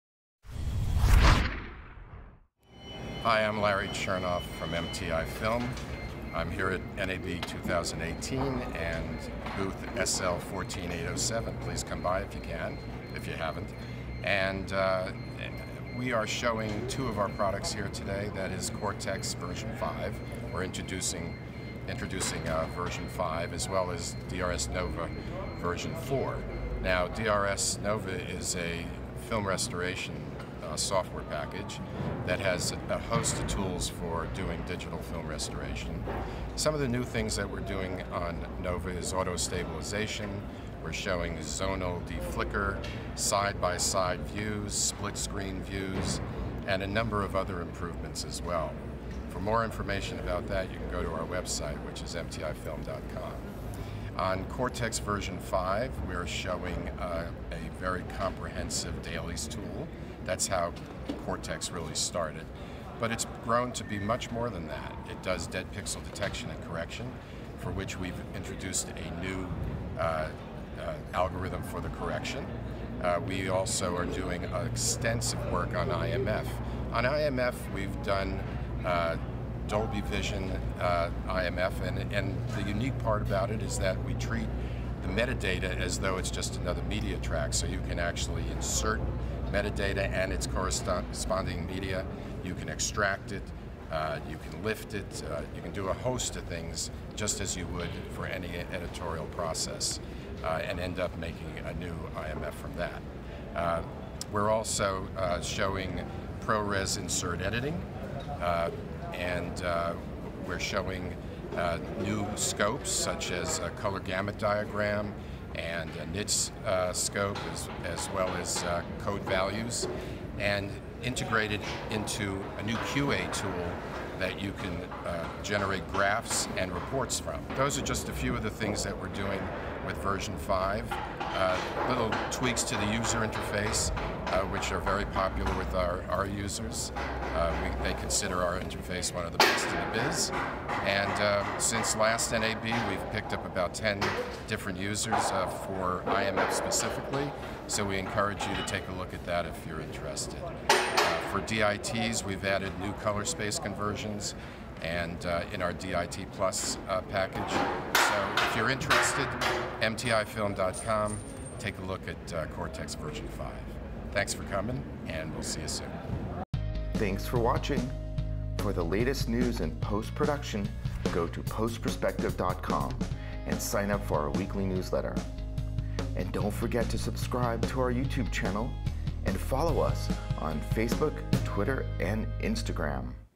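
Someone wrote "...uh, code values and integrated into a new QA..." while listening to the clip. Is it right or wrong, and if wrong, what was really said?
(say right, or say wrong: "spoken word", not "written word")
right.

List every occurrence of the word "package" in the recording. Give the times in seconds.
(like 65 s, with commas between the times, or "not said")
31 s, 157 s.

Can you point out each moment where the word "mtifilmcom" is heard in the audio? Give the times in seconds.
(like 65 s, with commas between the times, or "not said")
52 s, 159 s.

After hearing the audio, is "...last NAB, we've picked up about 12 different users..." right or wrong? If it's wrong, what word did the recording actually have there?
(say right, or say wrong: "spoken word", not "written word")
wrong: "10", not "12".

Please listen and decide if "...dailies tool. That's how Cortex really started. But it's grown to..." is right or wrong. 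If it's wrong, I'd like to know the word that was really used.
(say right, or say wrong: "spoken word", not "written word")
right.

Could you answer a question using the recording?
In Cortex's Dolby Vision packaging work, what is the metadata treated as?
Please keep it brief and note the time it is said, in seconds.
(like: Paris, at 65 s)
Another media track, at 86 s.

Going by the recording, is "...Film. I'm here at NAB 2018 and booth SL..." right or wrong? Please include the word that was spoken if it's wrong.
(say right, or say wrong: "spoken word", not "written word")
right.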